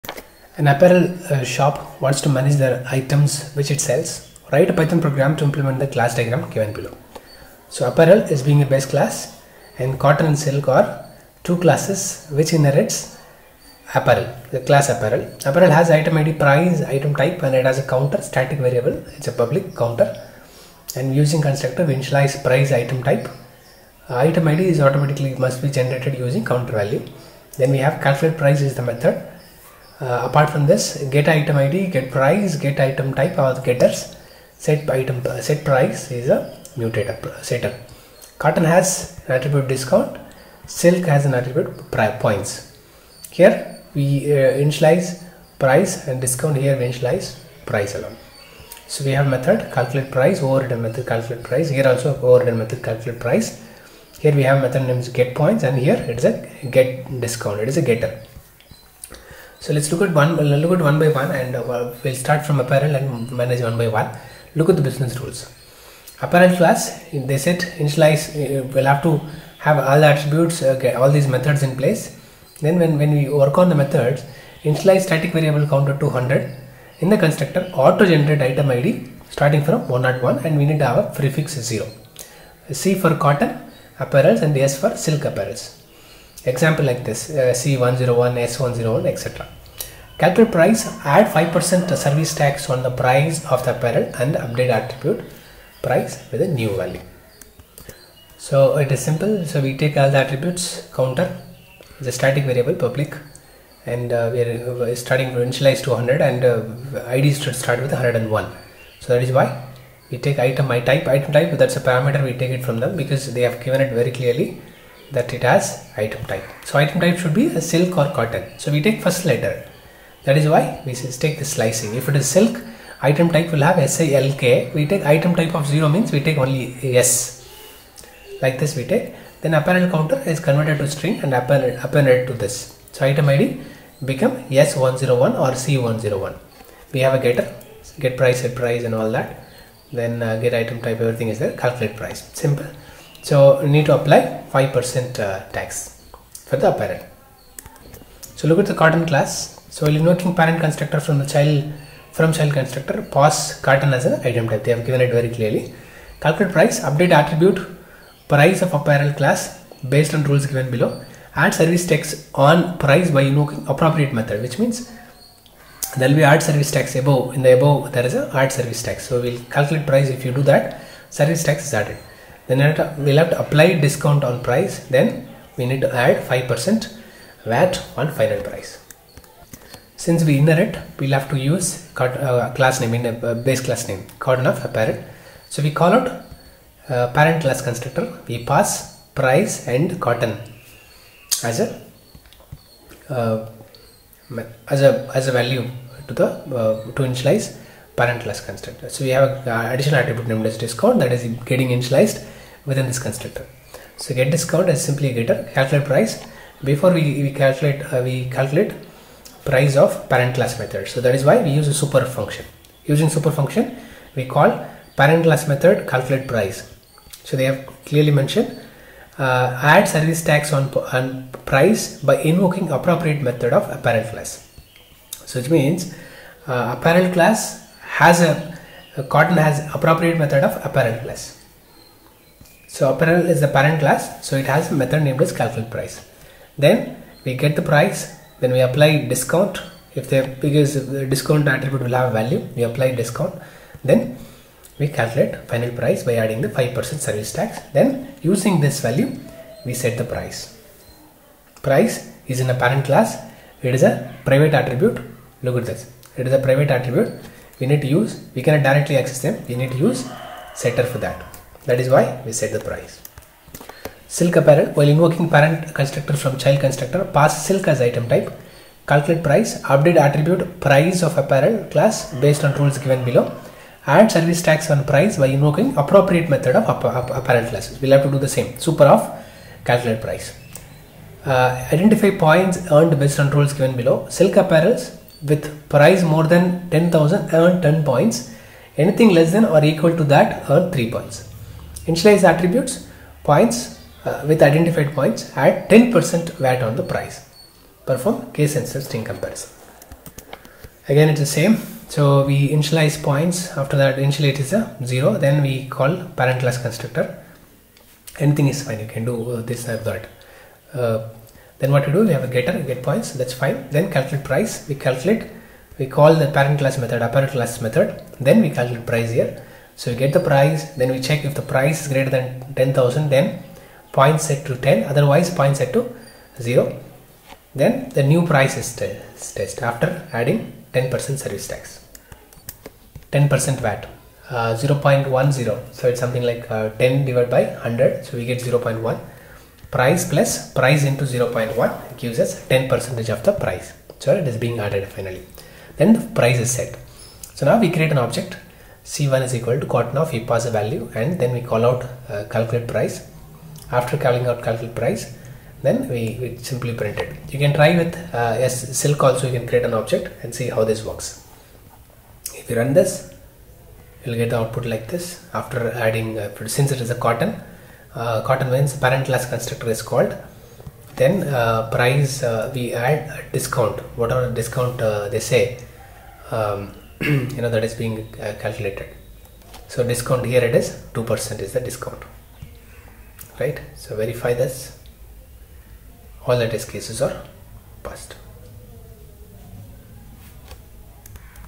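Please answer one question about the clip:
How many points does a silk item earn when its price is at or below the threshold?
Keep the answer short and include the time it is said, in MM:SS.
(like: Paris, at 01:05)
3, at 04:50.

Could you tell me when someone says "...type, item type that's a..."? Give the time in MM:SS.
01:50.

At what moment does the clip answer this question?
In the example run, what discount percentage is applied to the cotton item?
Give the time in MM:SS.
06:20.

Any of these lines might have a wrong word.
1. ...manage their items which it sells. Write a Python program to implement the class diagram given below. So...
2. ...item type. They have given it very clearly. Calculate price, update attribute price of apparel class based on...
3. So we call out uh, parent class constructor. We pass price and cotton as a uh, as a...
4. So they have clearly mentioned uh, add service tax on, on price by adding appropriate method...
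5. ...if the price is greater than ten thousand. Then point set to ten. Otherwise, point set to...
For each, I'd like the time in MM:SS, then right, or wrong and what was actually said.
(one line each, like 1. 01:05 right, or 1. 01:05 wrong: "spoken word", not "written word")
1. 00:02 right
2. 02:34 right
3. 03:05 right
4. 03:37 wrong: "invoking", not "adding"
5. 05:21 right.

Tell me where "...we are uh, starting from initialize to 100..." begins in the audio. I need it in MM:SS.
01:44.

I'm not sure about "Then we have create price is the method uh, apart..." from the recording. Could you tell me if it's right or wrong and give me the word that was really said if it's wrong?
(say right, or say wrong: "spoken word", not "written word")
wrong: "calculate", not "create".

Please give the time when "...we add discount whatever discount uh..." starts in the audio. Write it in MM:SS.
06:12.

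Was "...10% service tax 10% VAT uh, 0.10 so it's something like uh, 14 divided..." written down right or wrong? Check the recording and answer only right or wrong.
wrong.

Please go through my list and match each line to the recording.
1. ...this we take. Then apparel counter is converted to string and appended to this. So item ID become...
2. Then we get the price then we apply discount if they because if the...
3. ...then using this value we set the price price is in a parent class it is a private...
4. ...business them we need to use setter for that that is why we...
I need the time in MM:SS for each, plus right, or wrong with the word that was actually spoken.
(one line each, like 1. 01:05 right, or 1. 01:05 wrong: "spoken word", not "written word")
1. 02:08 right
2. 03:56 right
3. 04:07 right
4. 04:19 wrong: "access", not "business".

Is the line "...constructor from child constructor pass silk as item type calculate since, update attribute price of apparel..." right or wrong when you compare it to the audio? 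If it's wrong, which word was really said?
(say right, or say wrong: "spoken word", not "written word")
wrong: "price", not "since".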